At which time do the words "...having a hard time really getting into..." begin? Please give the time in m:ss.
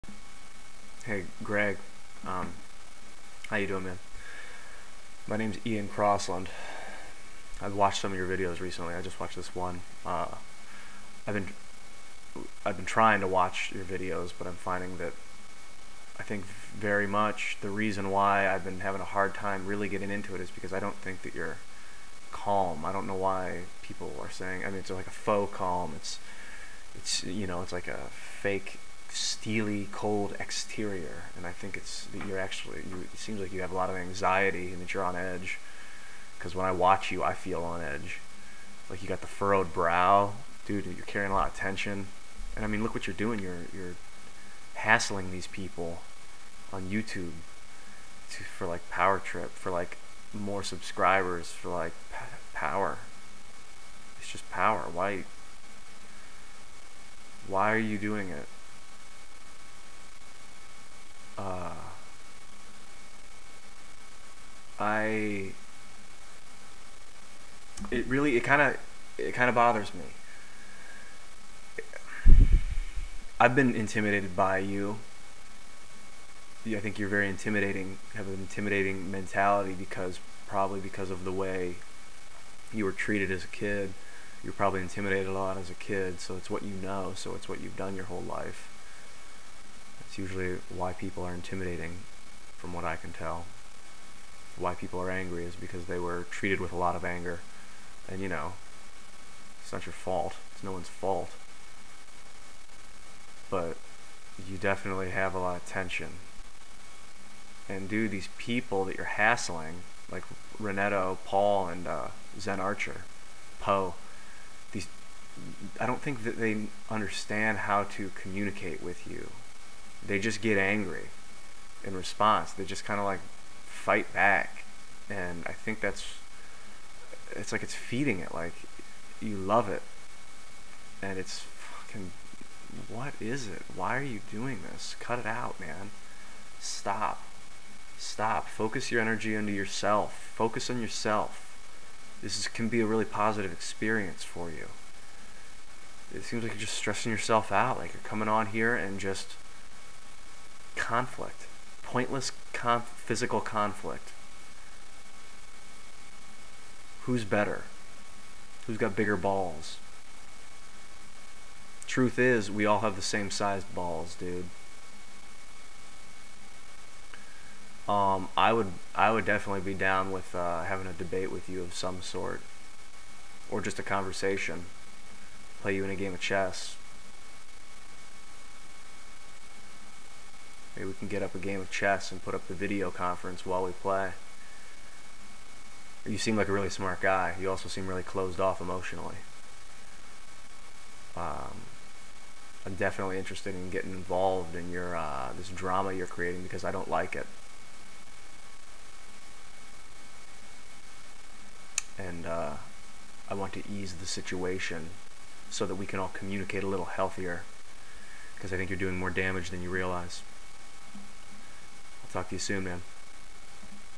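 0:18.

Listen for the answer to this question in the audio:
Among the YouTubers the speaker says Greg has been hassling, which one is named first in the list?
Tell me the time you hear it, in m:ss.
1:50.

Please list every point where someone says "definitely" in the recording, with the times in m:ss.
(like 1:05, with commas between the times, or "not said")
1:44, 2:49, 3:12.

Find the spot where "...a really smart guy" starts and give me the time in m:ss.
3:06.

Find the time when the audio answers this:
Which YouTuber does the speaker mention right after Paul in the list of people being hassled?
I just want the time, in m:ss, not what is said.
1:52.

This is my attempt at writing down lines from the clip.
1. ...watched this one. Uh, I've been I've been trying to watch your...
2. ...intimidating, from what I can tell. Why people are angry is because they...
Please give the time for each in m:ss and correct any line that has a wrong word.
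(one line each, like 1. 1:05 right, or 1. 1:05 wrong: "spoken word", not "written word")
1. 0:09 right
2. 1:31 right.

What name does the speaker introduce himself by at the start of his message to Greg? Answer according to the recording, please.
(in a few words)
Ian Crossland.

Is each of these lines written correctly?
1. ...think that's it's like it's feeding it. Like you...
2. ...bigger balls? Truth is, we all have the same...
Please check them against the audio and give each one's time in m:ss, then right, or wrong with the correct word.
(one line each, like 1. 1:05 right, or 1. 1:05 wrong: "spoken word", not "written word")
1. 2:05 right
2. 2:38 right.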